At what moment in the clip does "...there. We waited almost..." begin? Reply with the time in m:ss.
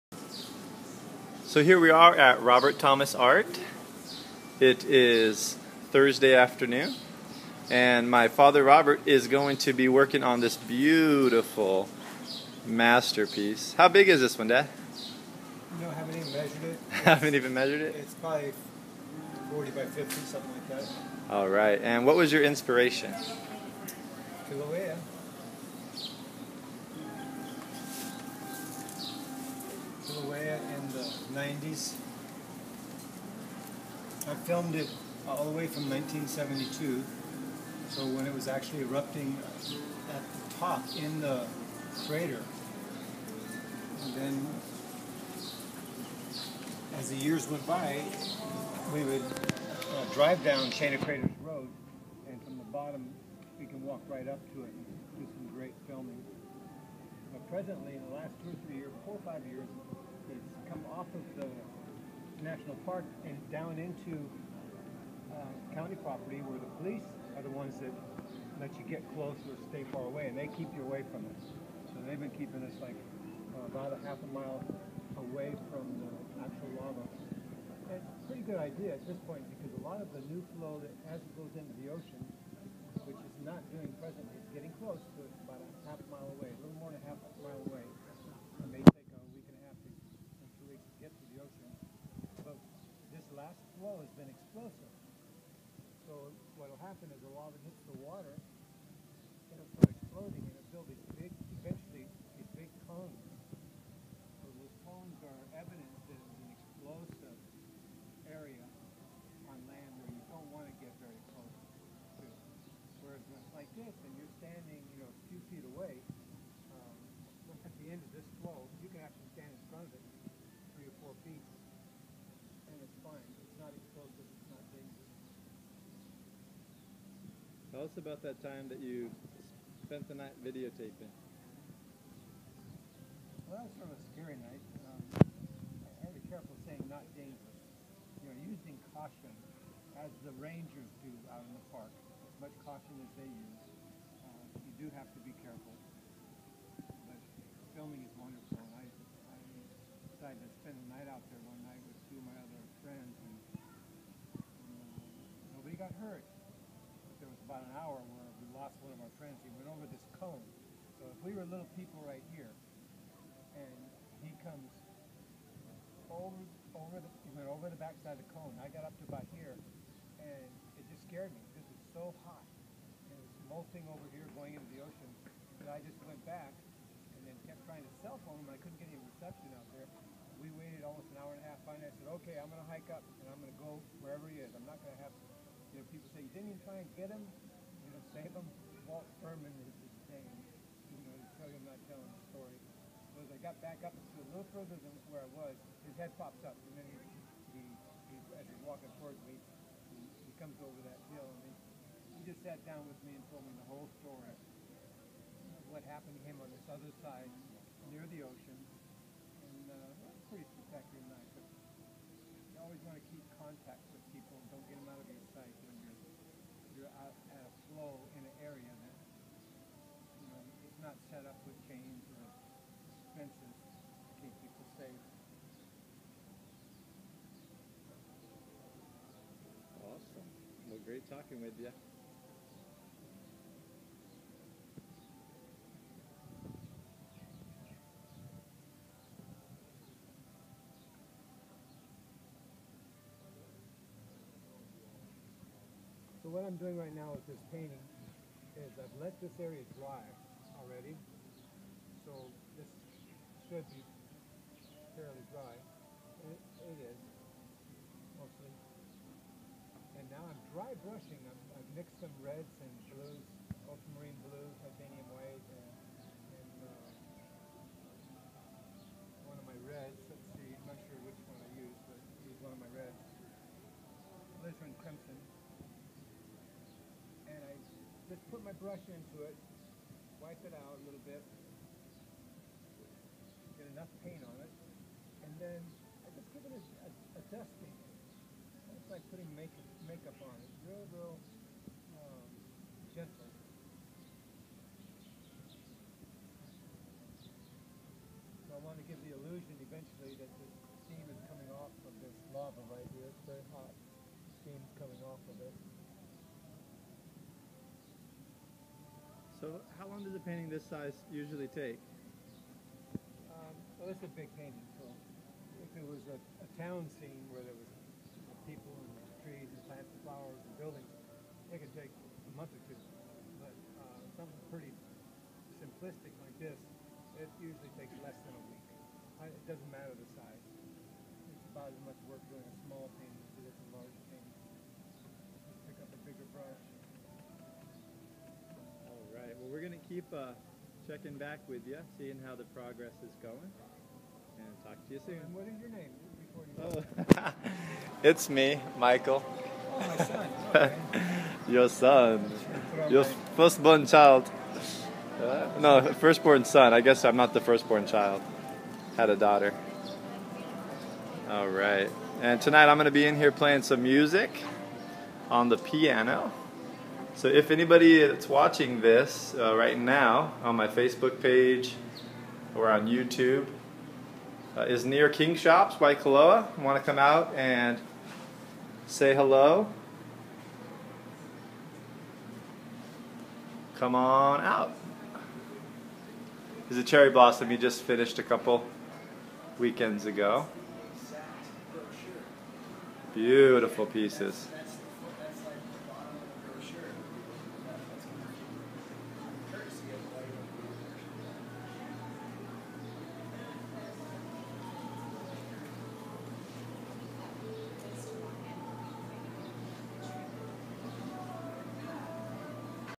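2:59.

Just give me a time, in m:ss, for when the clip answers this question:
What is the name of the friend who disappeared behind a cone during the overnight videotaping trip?
3:08.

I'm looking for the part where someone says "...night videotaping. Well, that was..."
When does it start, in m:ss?
2:10.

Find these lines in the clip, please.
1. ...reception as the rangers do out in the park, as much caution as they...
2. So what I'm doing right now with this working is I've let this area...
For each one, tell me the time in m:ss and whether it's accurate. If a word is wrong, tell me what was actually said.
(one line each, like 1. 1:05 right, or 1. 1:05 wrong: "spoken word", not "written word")
1. 2:18 wrong: "caution", not "reception"
2. 4:06 wrong: "painting", not "working".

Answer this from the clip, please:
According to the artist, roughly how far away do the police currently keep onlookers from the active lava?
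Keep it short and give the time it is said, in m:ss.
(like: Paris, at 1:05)
half a mile, at 1:13.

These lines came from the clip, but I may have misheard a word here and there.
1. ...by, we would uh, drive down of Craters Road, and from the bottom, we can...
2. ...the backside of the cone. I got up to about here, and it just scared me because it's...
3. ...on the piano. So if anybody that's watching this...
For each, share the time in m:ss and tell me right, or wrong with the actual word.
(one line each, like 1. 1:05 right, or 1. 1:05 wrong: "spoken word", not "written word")
1. 0:47 right
2. 2:47 right
3. 6:05 right.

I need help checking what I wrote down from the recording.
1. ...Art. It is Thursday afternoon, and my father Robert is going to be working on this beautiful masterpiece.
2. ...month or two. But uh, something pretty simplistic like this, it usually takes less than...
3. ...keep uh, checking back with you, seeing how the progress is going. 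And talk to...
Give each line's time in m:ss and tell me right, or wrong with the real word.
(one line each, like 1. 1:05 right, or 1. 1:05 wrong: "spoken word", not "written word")
1. 0:03 right
2. 5:22 right
3. 5:39 right.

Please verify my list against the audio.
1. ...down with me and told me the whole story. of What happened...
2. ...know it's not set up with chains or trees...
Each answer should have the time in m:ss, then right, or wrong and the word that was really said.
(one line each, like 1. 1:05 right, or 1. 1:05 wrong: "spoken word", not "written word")
1. 3:22 right
2. 3:40 wrong: "fences", not "trees".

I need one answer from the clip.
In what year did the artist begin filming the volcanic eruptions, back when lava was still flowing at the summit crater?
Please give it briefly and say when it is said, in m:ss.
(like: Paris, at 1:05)
1972, at 0:35.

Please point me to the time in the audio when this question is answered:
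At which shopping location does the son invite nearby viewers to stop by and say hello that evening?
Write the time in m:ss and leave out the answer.
6:15.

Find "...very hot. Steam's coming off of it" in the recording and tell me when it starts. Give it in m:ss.
5:03.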